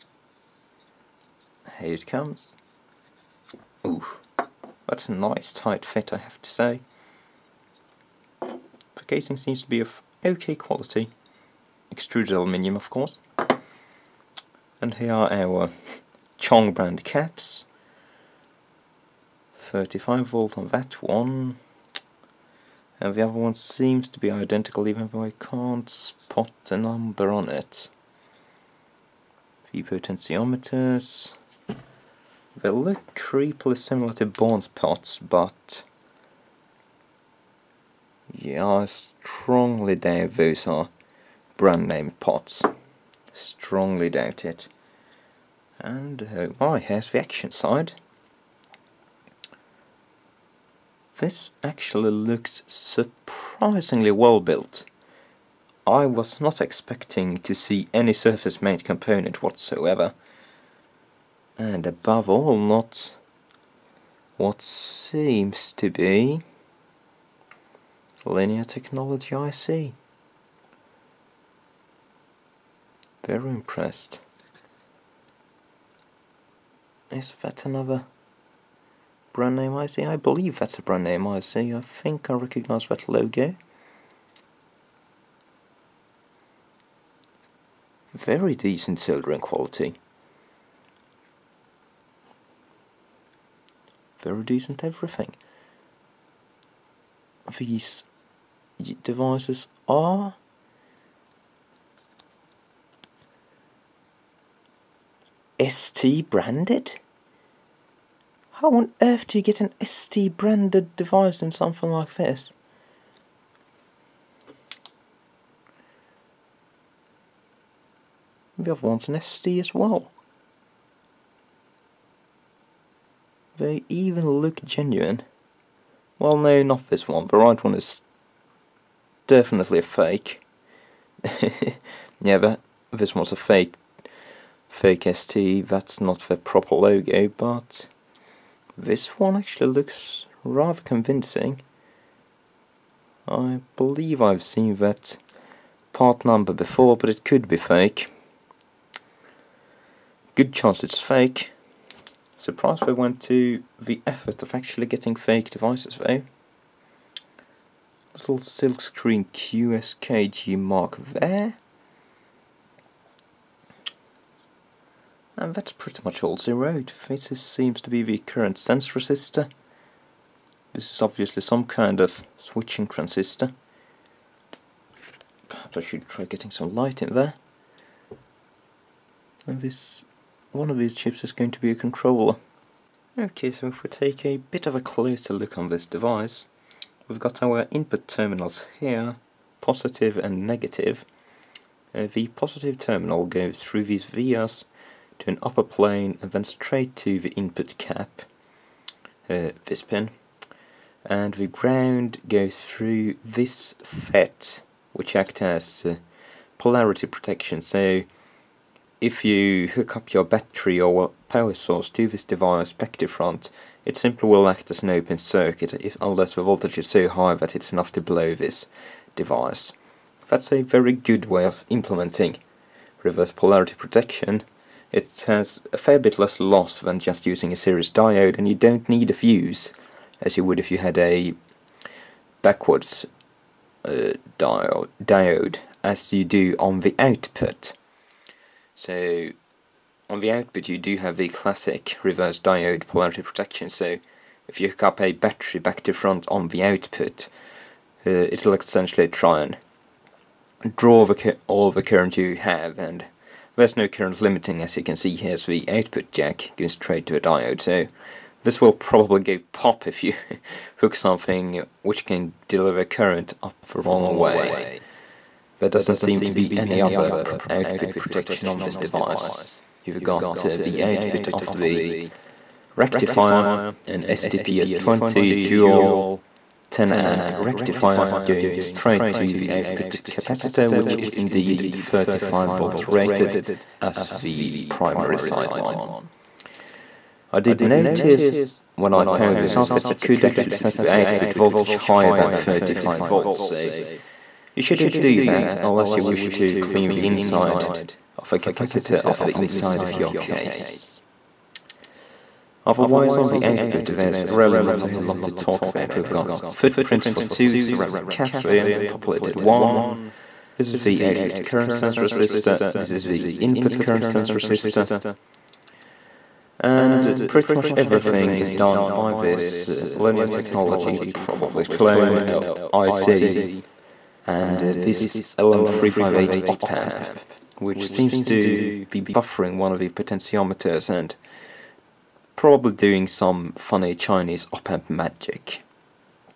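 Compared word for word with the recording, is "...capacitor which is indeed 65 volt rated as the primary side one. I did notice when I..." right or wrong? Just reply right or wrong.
wrong.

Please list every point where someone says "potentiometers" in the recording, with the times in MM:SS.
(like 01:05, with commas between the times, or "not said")
00:29, 05:29.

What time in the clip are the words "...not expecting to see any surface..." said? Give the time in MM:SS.
00:56.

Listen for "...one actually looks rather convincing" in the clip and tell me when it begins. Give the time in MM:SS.
02:19.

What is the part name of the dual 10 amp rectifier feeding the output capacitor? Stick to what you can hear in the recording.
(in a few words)
STPS20.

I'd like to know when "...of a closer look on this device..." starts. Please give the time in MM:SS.
03:04.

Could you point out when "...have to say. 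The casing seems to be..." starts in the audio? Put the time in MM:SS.
00:06.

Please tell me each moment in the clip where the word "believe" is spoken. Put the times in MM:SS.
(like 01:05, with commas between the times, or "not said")
01:20, 02:23.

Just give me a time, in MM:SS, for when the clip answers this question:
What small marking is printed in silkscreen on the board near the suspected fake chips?
02:39.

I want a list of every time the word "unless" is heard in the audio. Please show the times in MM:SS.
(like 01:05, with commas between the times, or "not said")
03:36, 04:55.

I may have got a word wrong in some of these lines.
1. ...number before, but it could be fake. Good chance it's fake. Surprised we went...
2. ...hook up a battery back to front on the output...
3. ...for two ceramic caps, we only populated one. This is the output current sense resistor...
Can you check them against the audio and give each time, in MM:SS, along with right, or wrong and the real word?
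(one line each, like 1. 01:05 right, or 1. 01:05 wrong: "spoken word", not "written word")
1. 02:26 right
2. 04:04 right
3. 05:07 right.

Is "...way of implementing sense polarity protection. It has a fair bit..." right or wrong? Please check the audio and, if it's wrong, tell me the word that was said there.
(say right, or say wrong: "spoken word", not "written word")
wrong: "reverse", not "sense".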